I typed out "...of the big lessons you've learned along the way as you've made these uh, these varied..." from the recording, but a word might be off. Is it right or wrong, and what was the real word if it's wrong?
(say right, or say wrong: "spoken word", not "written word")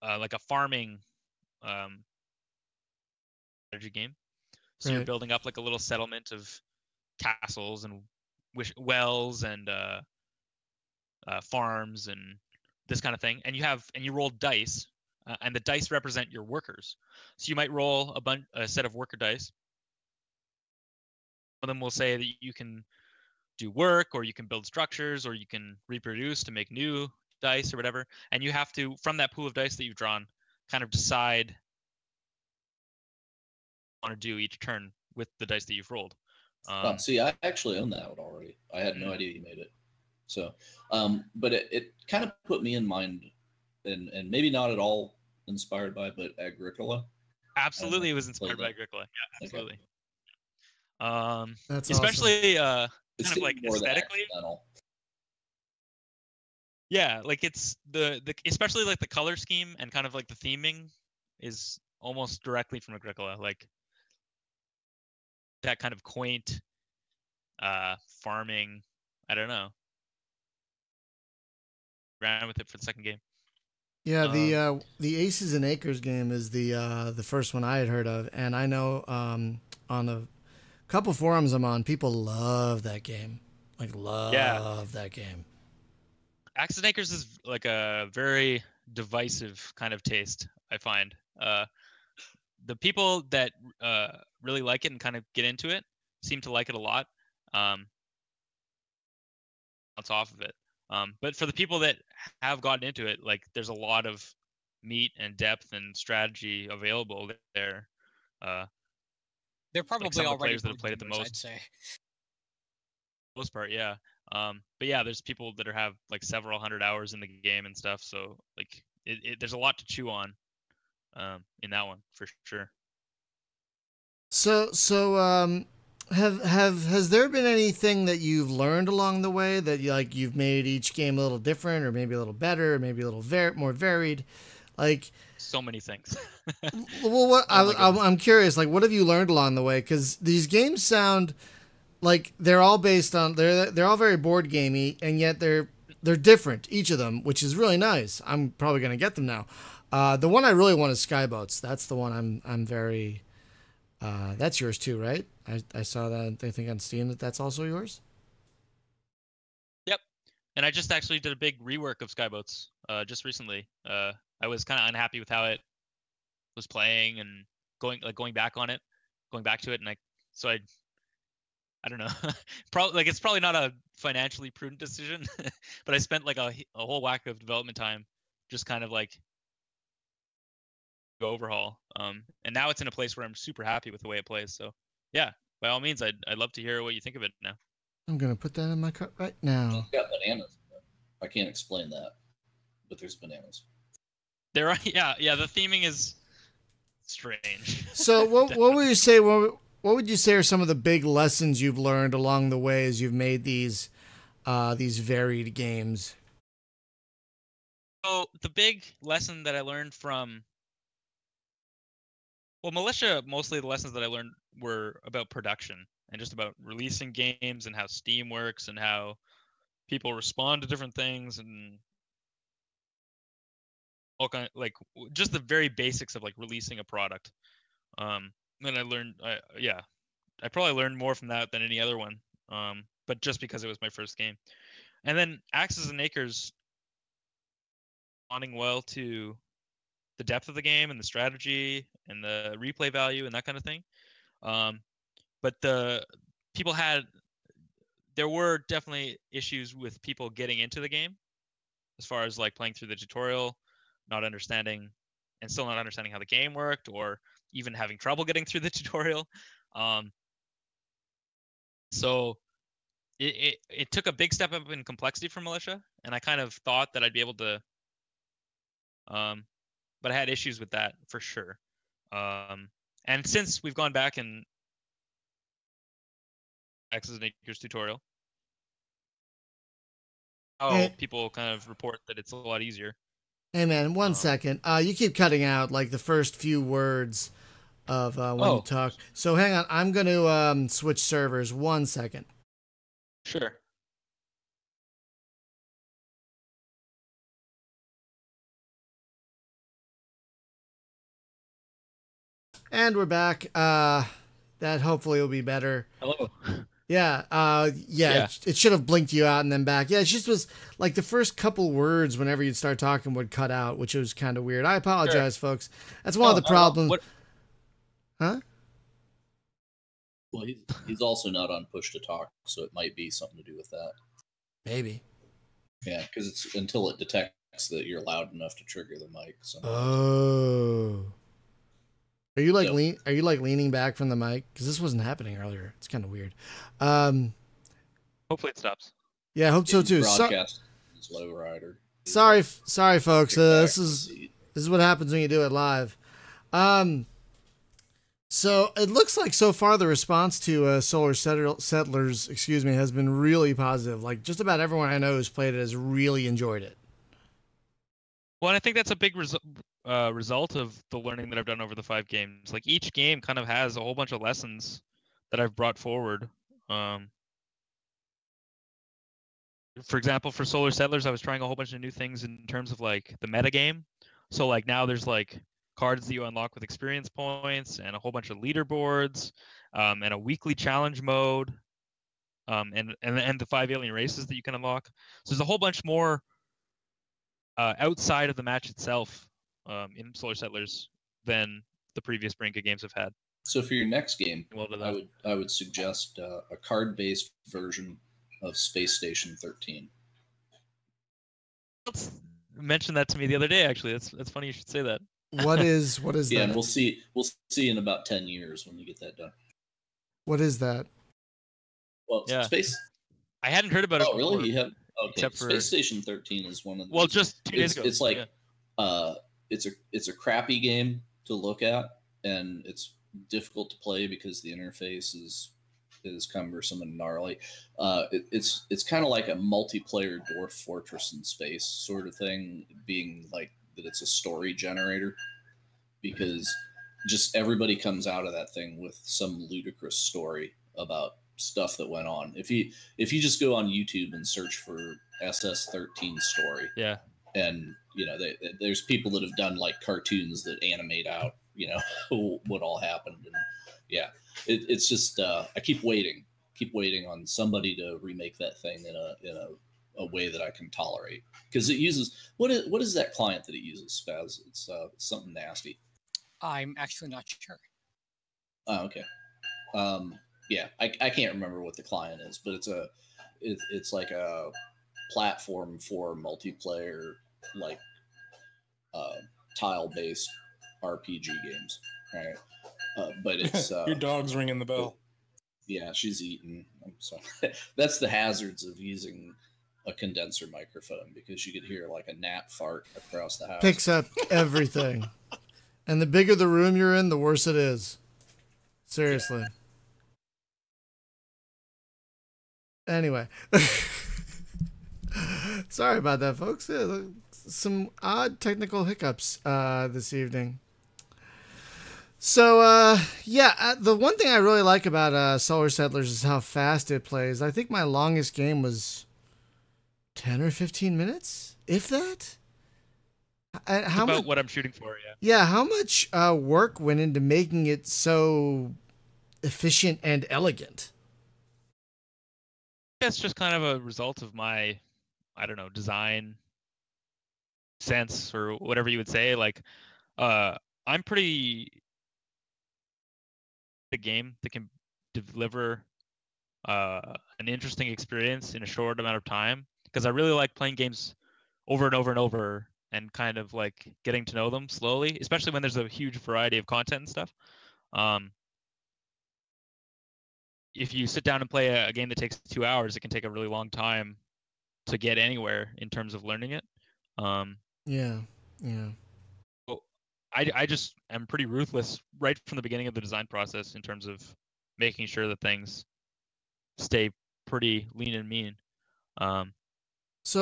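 right.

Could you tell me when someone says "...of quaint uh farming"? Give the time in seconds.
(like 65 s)
65 s.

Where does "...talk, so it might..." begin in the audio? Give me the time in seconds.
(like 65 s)
322 s.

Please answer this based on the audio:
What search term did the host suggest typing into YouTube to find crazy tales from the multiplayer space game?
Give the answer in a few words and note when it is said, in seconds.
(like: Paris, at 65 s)
SS13 story, at 445 s.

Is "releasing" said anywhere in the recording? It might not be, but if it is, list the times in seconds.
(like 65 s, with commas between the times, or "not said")
216 s, 226 s.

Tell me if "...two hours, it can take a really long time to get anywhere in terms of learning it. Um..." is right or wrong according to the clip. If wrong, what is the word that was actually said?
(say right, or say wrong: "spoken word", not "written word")
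right.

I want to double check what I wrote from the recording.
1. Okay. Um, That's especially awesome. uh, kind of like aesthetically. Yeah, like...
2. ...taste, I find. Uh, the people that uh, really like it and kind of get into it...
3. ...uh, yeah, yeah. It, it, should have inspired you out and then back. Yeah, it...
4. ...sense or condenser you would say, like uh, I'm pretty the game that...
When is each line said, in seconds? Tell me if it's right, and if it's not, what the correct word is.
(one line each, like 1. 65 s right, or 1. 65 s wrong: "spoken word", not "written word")
1. 51 s right
2. 90 s right
3. 307 s wrong: "blinked", not "inspired"
4. 537 s wrong: "whatever", not "condenser".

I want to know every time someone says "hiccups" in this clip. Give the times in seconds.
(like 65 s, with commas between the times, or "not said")
508 s.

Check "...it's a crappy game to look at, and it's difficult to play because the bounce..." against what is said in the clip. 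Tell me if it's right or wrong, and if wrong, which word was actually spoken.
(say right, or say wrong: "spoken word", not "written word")
wrong: "interface", not "bounce".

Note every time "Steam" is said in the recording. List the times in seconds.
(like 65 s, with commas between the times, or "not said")
156 s, 217 s.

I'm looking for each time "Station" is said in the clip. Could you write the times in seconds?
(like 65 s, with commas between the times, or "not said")
398 s, 415 s.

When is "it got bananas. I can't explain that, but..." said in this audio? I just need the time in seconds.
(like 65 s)
189 s.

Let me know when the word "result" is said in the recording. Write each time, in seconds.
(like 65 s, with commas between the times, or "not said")
360 s, 533 s.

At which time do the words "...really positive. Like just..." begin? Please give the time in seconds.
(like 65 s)
353 s.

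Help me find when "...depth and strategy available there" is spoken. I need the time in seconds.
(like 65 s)
105 s.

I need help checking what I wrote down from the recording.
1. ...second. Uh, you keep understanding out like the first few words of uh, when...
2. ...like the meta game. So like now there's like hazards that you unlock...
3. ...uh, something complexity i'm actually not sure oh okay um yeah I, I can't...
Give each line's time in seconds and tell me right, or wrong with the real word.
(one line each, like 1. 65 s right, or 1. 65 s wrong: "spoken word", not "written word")
1. 284 s wrong: "cutting", not "understanding"
2. 372 s wrong: "cards", not "hazards"
3. 464 s wrong: "nasty", not "complexity".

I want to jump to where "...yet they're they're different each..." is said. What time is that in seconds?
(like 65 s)
145 s.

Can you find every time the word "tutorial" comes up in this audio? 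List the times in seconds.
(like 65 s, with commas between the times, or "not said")
252 s, 258 s, 277 s.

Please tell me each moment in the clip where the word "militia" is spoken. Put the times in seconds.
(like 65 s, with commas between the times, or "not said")
212 s, 265 s.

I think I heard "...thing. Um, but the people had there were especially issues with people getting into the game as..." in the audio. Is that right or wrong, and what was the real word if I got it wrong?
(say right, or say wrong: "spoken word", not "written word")
wrong: "definitely", not "especially".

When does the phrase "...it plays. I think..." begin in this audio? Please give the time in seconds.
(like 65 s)
516 s.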